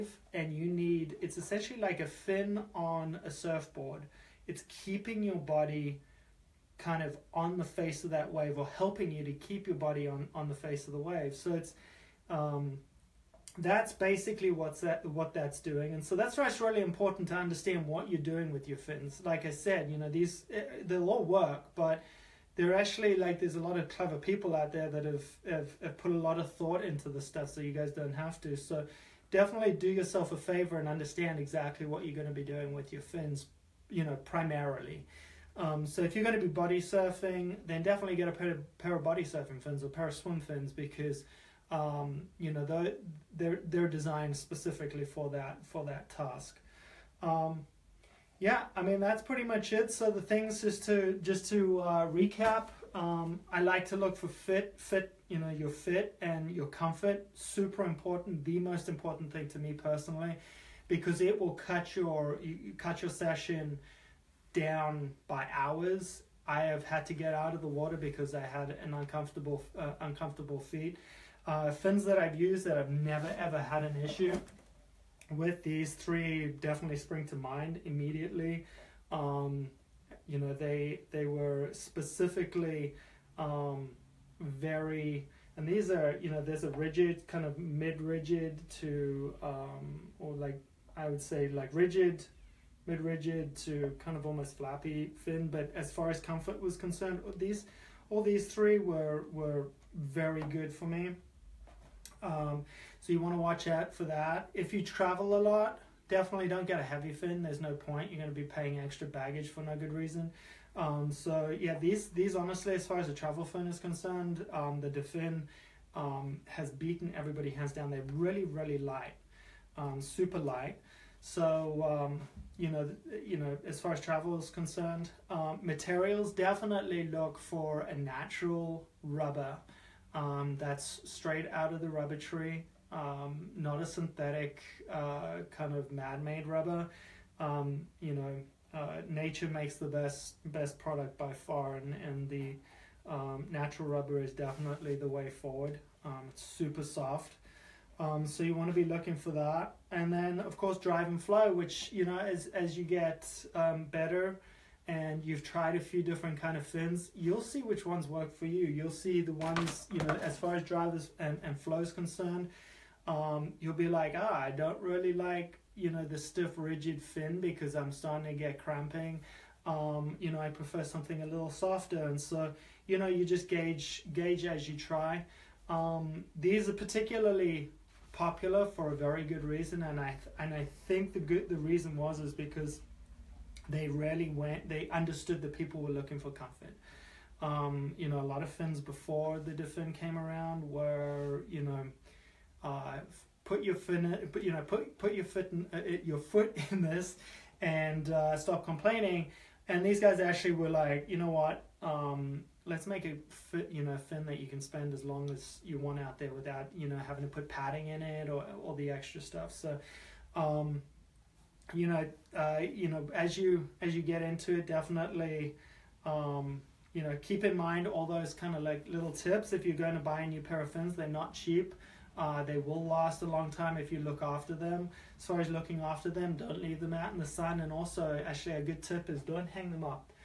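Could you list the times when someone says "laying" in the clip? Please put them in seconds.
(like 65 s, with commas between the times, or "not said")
not said.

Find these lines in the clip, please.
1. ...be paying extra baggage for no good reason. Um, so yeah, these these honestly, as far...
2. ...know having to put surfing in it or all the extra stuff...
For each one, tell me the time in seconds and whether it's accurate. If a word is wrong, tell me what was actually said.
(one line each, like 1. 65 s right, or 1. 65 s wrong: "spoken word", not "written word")
1. 108 s right
2. 206 s wrong: "padding", not "surfing".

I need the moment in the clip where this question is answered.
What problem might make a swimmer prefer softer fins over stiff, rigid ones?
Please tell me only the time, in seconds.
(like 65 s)
168 s.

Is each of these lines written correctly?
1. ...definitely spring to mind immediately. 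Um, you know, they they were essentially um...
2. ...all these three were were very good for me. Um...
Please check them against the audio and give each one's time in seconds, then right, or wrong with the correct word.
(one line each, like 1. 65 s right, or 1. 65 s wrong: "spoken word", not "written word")
1. 76 s wrong: "specifically", not "essentially"
2. 98 s right.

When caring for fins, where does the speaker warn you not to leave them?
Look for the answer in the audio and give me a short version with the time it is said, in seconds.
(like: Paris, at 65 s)
In the sun, at 227 s.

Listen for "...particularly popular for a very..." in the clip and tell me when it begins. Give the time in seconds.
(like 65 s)
176 s.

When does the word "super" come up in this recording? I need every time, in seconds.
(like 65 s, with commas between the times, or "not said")
57 s, 119 s, 146 s.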